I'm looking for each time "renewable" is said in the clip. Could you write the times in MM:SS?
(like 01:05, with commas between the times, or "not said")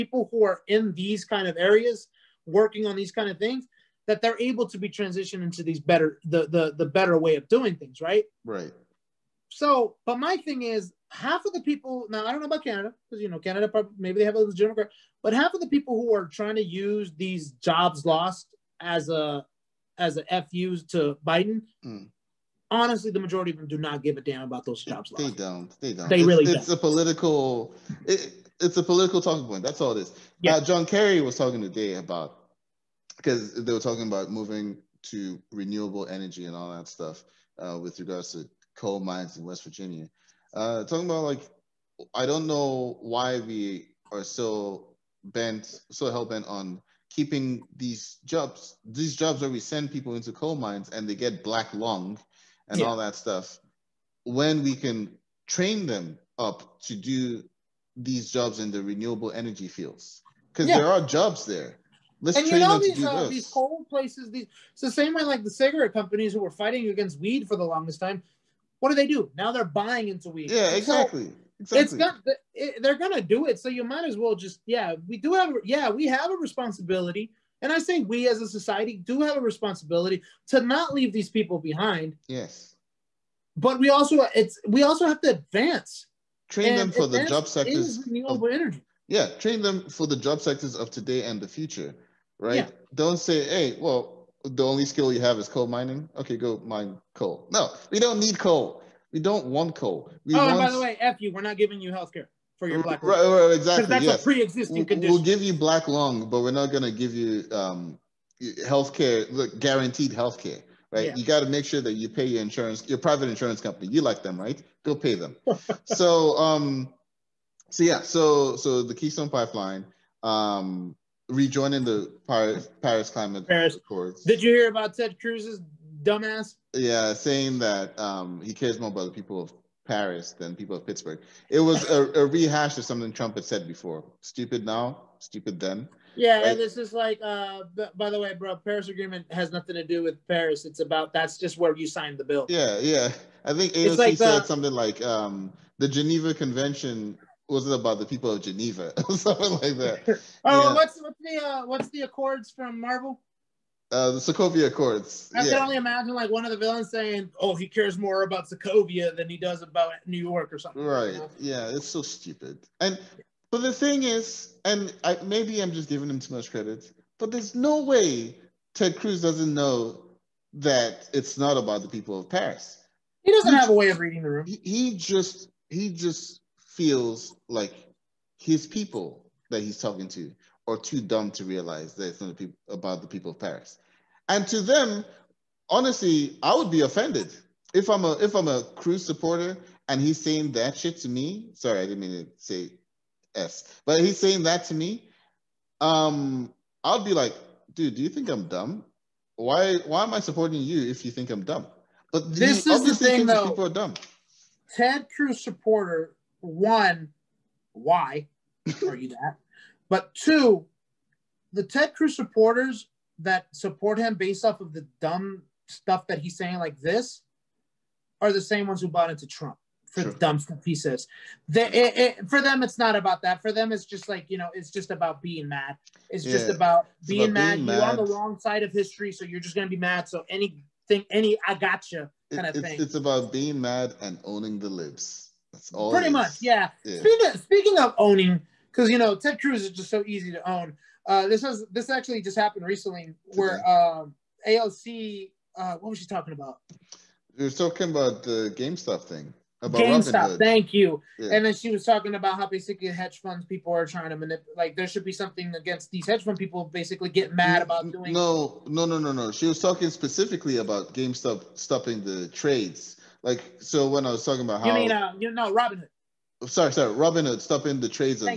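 00:35, 00:58, 01:28.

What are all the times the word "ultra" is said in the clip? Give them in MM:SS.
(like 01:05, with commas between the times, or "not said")
not said.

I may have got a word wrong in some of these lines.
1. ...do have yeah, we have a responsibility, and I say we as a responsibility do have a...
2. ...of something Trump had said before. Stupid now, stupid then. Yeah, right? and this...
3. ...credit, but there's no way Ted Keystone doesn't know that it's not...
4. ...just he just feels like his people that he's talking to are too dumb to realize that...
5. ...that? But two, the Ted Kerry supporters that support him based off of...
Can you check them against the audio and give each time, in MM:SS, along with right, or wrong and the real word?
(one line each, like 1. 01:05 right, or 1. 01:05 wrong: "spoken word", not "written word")
1. 01:15 wrong: "society", not "responsibility"
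2. 02:12 right
3. 02:46 wrong: "Cruz", not "Keystone"
4. 02:54 right
5. 03:29 wrong: "Cruz", not "Kerry".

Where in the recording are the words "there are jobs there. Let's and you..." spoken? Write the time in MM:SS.
01:00.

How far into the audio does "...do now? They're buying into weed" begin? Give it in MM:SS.
01:09.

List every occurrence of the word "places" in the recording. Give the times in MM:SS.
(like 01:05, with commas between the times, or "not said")
01:03.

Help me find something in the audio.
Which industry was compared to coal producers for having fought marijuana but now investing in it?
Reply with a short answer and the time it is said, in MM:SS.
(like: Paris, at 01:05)
cigarette companies, at 01:05.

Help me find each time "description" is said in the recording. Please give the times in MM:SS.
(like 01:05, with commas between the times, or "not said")
not said.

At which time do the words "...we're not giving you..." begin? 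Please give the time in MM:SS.
01:41.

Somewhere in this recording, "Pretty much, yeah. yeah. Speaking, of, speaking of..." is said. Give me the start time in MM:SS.
03:55.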